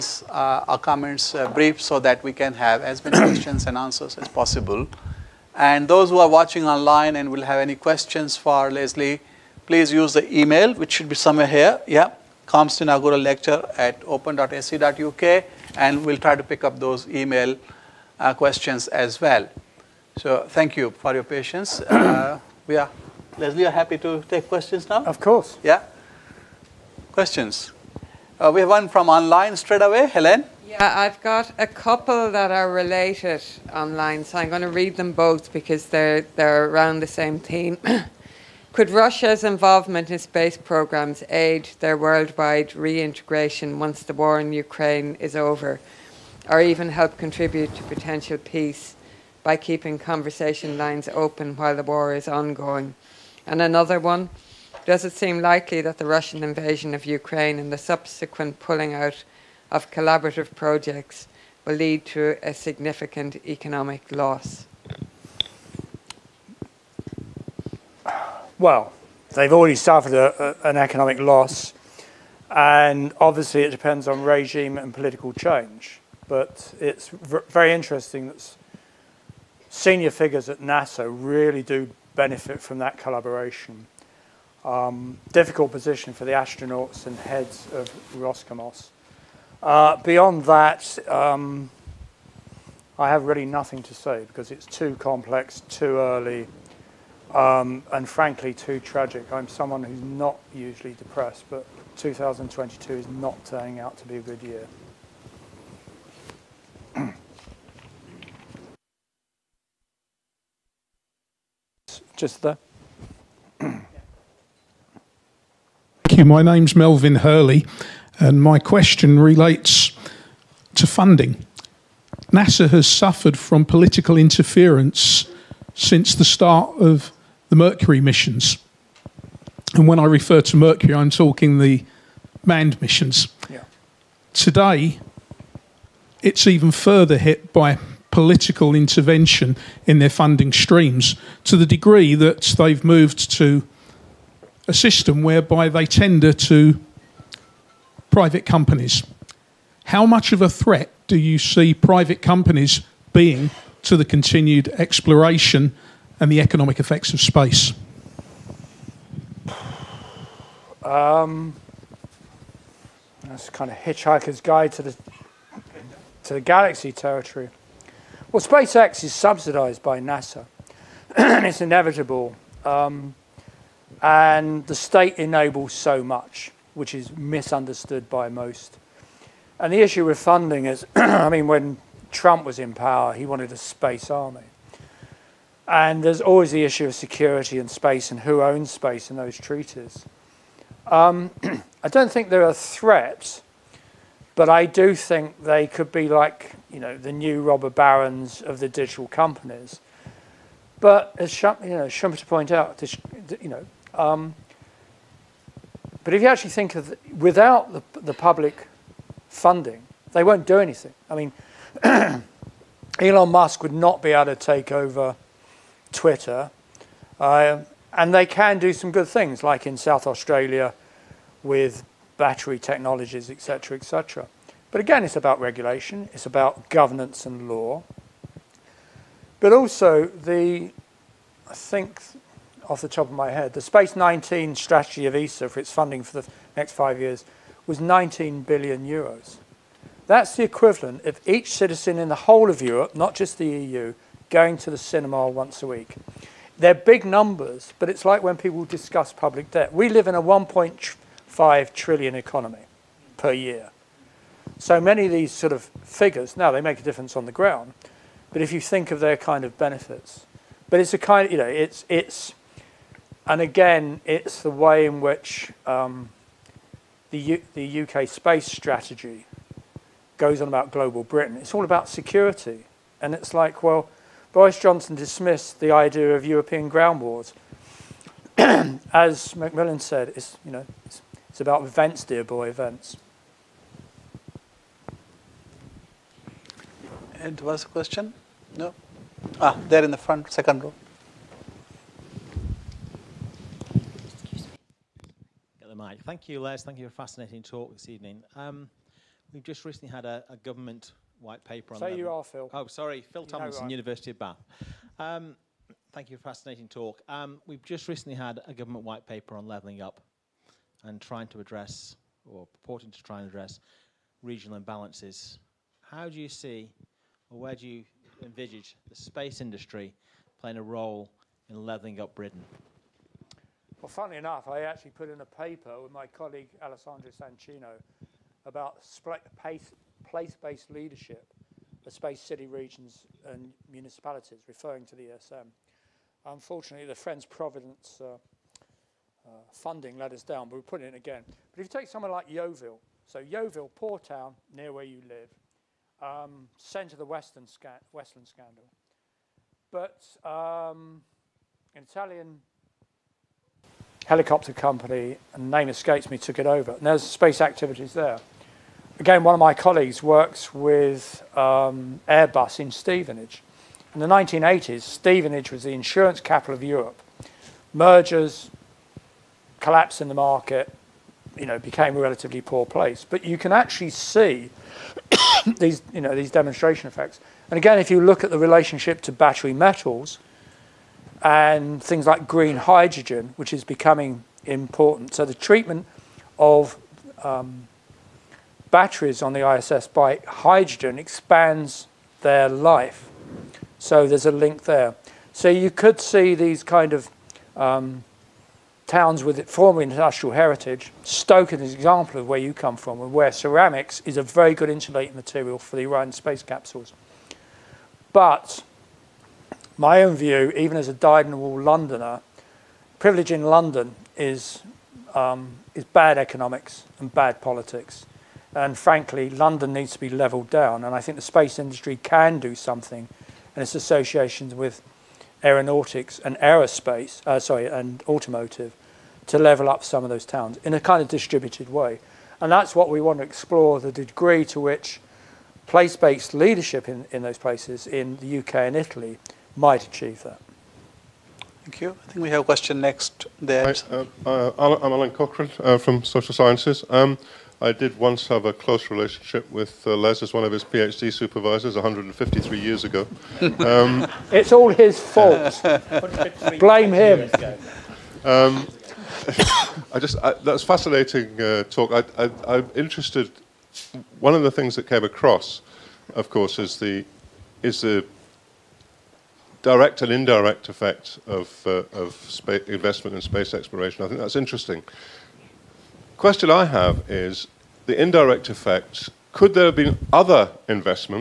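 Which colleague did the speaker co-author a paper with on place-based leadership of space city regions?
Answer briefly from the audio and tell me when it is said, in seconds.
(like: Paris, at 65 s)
Alessandro Sancino, at 326 s.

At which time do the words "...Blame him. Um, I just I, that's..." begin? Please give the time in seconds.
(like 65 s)
456 s.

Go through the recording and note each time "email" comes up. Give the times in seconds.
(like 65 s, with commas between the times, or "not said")
10 s, 17 s.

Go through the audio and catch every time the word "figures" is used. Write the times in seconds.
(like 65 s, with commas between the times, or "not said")
80 s, 255 s.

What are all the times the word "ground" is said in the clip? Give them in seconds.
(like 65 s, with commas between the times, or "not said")
257 s, 276 s.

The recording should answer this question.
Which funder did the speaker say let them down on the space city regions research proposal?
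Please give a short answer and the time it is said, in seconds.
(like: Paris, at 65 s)
Friends Provident, at 336 s.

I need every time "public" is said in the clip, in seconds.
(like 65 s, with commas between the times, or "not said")
208 s, 249 s.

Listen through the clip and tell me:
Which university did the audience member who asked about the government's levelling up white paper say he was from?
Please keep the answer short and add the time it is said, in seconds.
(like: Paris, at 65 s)
University of Bath, at 303 s.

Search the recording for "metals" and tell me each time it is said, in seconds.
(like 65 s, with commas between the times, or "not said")
379 s.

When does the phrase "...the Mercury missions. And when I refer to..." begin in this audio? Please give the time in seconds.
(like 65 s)
127 s.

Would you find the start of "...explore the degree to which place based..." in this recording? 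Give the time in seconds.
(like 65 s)
433 s.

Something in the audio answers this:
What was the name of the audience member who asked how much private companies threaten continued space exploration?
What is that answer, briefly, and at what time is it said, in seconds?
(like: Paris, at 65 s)
Melvin Hurley, at 116 s.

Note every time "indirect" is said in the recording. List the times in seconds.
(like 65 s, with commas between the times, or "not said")
470 s, 477 s.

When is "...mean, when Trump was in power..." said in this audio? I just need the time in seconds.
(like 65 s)
181 s.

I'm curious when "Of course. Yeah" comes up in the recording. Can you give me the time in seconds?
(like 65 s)
25 s.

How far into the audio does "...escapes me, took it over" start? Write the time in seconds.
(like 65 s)
355 s.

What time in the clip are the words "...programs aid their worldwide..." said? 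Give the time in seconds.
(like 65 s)
40 s.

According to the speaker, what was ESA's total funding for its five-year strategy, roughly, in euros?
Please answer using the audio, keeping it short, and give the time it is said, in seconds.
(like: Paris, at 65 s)
19 billion euros, at 237 s.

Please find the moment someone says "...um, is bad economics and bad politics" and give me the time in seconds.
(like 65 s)
415 s.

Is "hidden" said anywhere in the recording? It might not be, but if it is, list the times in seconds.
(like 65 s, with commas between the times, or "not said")
not said.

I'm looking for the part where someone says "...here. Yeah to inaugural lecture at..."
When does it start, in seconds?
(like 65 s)
11 s.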